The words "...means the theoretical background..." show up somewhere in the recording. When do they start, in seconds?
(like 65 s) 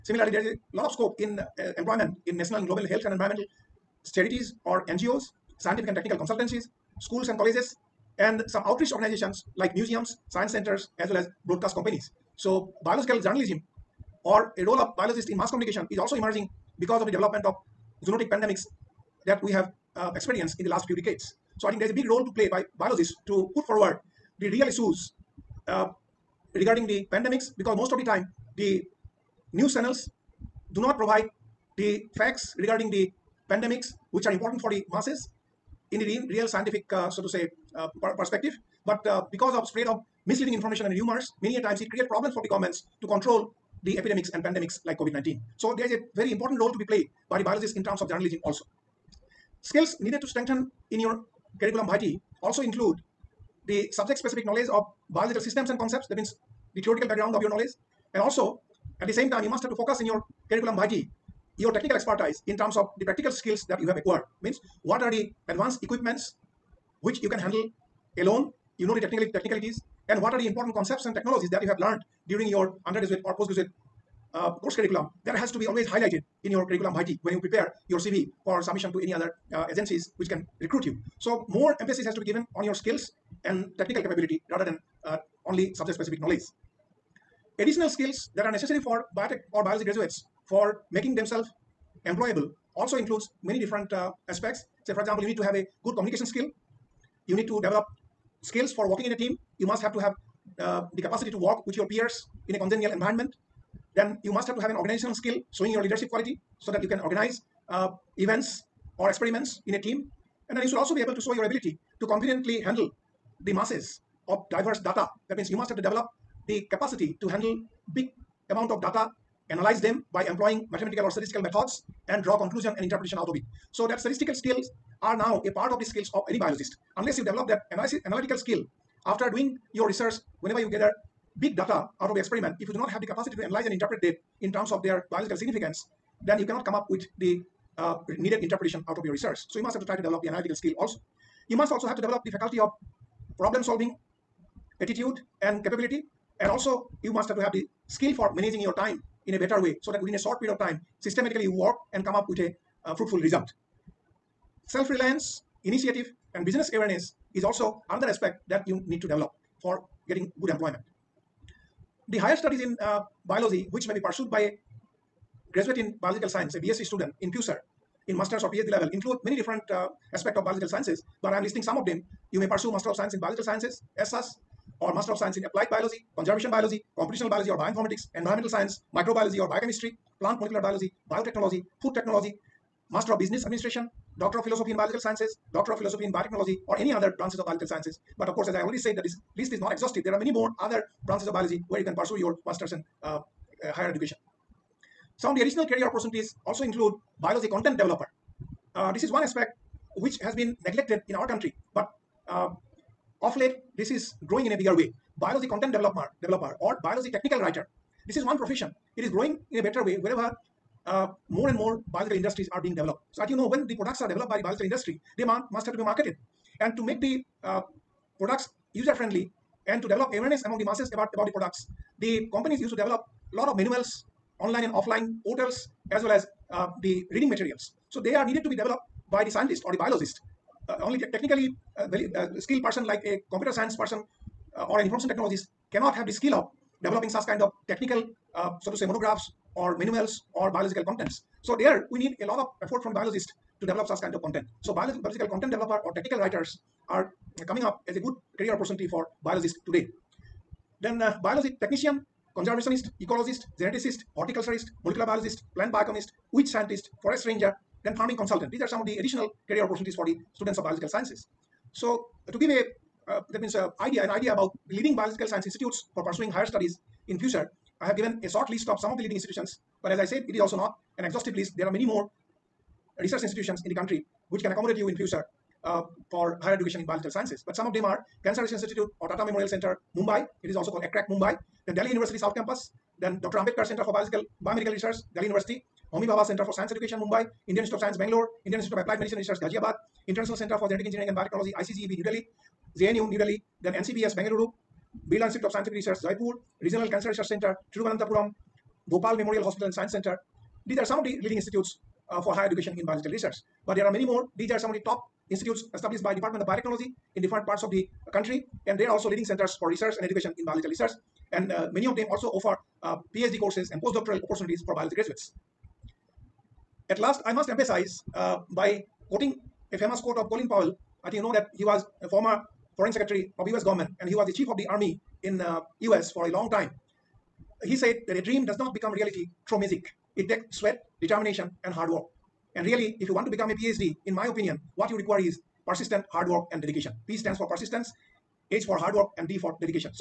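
56 s.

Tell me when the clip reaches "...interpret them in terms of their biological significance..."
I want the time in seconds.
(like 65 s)
133 s.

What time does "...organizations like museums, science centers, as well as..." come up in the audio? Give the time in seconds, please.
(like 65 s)
8 s.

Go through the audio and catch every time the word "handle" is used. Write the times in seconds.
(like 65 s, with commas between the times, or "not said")
67 s, 112 s, 117 s.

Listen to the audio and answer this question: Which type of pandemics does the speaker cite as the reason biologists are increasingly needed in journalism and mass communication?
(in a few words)
Zoonotic pandemics.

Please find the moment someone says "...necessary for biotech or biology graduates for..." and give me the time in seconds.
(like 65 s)
88 s.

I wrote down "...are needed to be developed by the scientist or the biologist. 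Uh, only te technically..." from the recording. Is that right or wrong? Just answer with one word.
right.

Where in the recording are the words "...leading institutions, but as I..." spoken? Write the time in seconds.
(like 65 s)
269 s.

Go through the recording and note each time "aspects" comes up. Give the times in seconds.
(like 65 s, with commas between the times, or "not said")
94 s, 158 s, 170 s, 199 s.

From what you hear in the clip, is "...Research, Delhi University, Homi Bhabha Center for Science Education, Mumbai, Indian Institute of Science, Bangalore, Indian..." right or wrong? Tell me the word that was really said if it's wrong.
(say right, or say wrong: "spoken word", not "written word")
right.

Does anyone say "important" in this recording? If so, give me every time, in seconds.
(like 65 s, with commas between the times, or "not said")
34 s, 46 s, 70 s.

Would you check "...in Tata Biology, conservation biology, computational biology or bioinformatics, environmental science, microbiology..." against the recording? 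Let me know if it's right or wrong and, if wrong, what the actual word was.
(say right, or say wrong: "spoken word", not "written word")
wrong: "Applied", not "Tata".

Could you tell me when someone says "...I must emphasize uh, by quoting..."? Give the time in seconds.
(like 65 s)
317 s.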